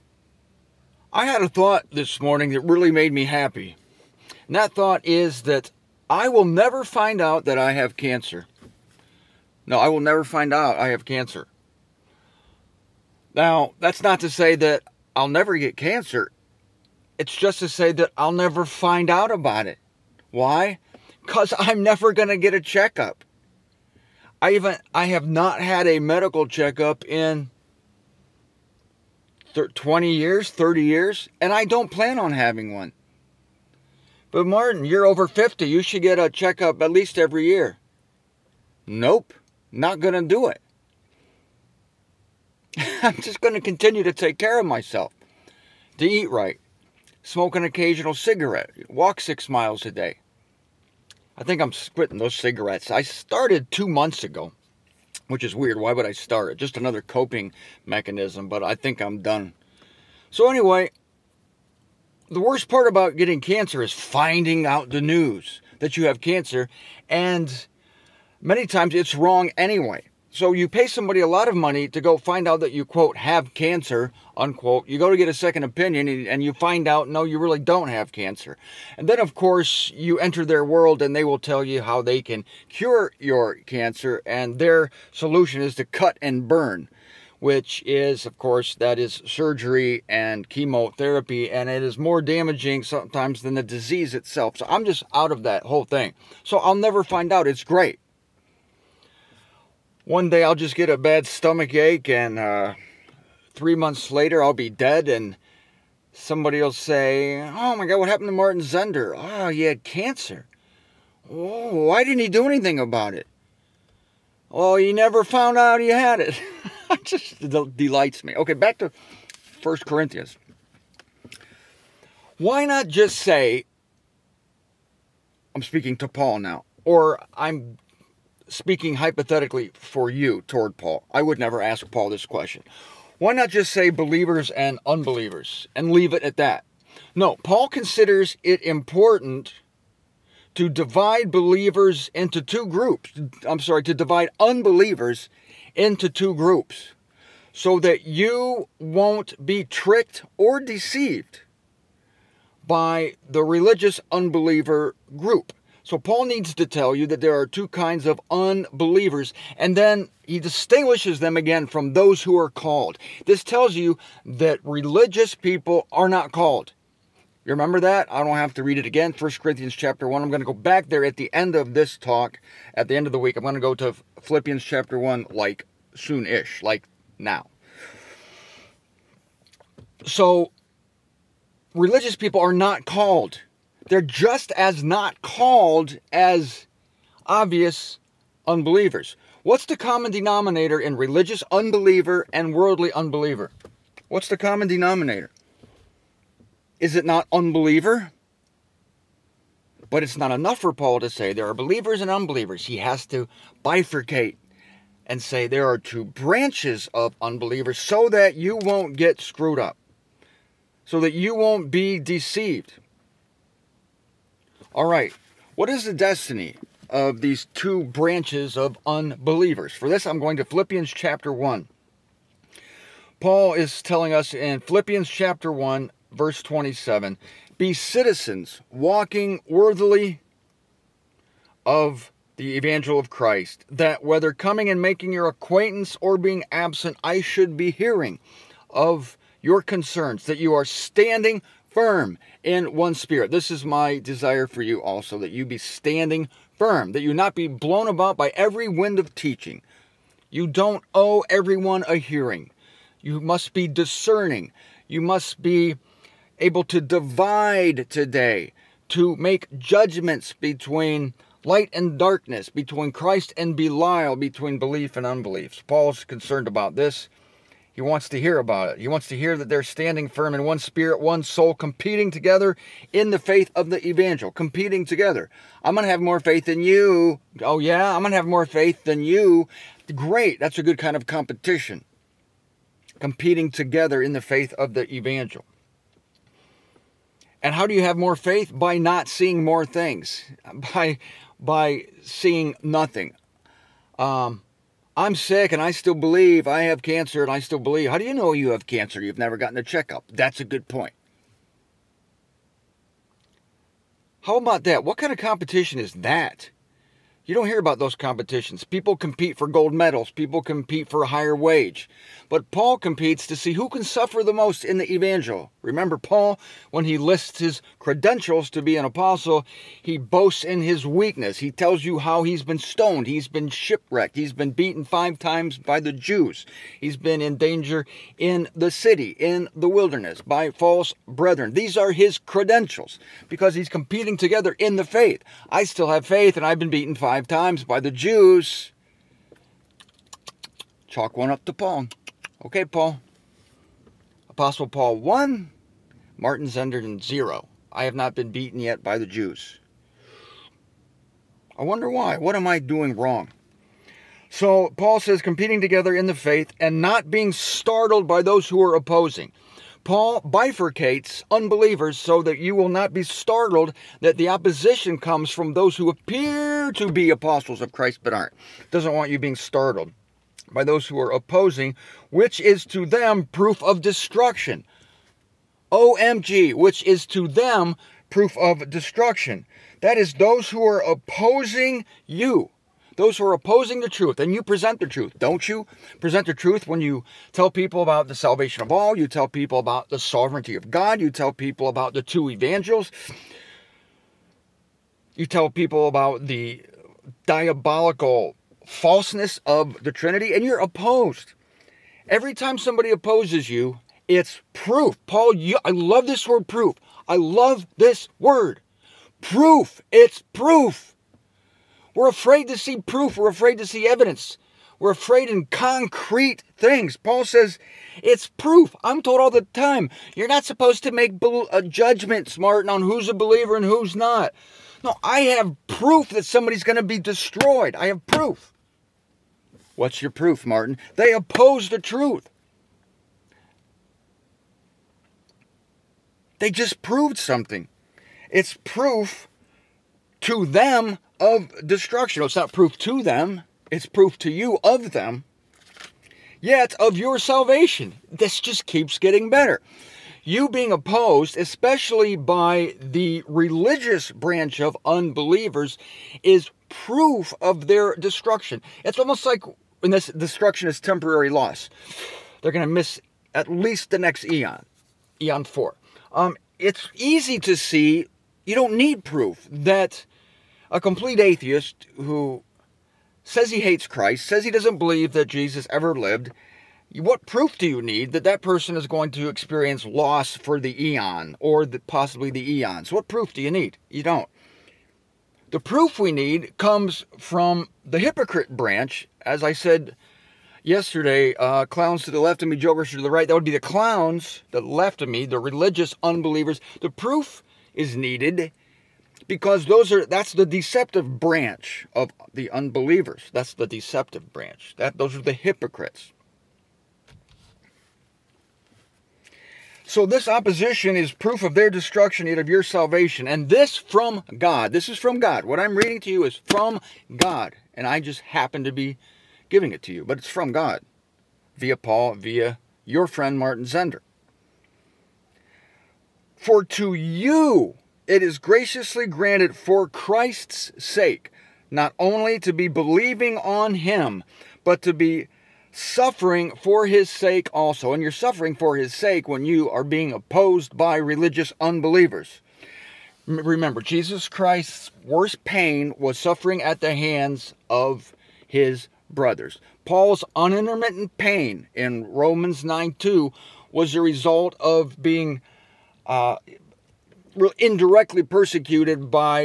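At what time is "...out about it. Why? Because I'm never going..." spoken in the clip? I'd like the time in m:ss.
0:19.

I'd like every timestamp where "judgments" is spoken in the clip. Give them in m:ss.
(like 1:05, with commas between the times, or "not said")
4:19, 7:01.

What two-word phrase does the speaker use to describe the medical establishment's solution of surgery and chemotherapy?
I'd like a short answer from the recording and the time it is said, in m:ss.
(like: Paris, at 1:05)
cut and burn, at 1:25.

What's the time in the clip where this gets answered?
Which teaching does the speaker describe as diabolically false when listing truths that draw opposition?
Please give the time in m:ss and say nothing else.
6:39.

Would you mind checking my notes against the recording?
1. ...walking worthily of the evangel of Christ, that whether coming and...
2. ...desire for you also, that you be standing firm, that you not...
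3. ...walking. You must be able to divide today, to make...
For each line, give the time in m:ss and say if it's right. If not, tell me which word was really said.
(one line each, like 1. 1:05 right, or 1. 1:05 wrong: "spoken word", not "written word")
1. 3:48 right
2. 4:03 right
3. 4:13 wrong: "discerning", not "walking".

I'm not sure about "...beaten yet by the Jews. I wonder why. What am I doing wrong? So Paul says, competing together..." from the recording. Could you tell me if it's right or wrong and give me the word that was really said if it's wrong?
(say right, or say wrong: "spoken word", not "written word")
right.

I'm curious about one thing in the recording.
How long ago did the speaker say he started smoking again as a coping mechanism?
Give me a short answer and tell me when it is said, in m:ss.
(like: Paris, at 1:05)
2 months, at 0:53.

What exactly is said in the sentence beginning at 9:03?
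Remember, Jesus Christ's worst pain was suffering at the hands of his brothers.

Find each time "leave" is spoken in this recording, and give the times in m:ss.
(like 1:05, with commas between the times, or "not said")
2:15.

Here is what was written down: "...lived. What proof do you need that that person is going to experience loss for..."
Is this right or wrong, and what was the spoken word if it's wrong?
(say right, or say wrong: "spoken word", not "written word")
right.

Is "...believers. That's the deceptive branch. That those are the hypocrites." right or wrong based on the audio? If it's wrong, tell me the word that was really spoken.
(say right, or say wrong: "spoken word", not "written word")
wrong: "unbelievers", not "believers".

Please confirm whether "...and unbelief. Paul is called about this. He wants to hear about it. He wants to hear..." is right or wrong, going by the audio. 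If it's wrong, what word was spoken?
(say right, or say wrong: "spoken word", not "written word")
wrong: "concerned", not "called".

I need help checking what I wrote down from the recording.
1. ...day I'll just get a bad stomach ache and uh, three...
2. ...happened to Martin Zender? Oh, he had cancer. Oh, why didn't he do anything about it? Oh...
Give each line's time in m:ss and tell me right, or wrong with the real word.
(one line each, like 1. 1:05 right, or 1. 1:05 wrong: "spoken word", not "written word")
1. 1:40 right
2. 1:48 right.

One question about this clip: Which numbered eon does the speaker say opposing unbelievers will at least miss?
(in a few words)
eon 4.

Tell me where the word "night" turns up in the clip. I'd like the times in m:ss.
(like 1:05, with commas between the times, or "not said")
not said.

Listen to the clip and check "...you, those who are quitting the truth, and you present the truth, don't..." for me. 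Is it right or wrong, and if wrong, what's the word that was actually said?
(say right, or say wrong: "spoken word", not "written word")
wrong: "opposing", not "quitting".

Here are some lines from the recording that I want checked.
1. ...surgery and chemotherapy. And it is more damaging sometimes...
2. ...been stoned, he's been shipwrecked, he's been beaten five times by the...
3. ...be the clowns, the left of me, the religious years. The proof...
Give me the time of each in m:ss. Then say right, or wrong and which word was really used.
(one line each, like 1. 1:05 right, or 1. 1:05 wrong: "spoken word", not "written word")
1. 1:29 right
2. 5:22 right
3. 8:13 wrong: "unbelievers", not "years".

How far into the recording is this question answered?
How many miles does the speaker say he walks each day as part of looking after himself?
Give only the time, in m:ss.
0:49.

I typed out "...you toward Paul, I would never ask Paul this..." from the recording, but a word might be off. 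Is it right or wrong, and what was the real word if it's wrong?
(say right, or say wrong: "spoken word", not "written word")
right.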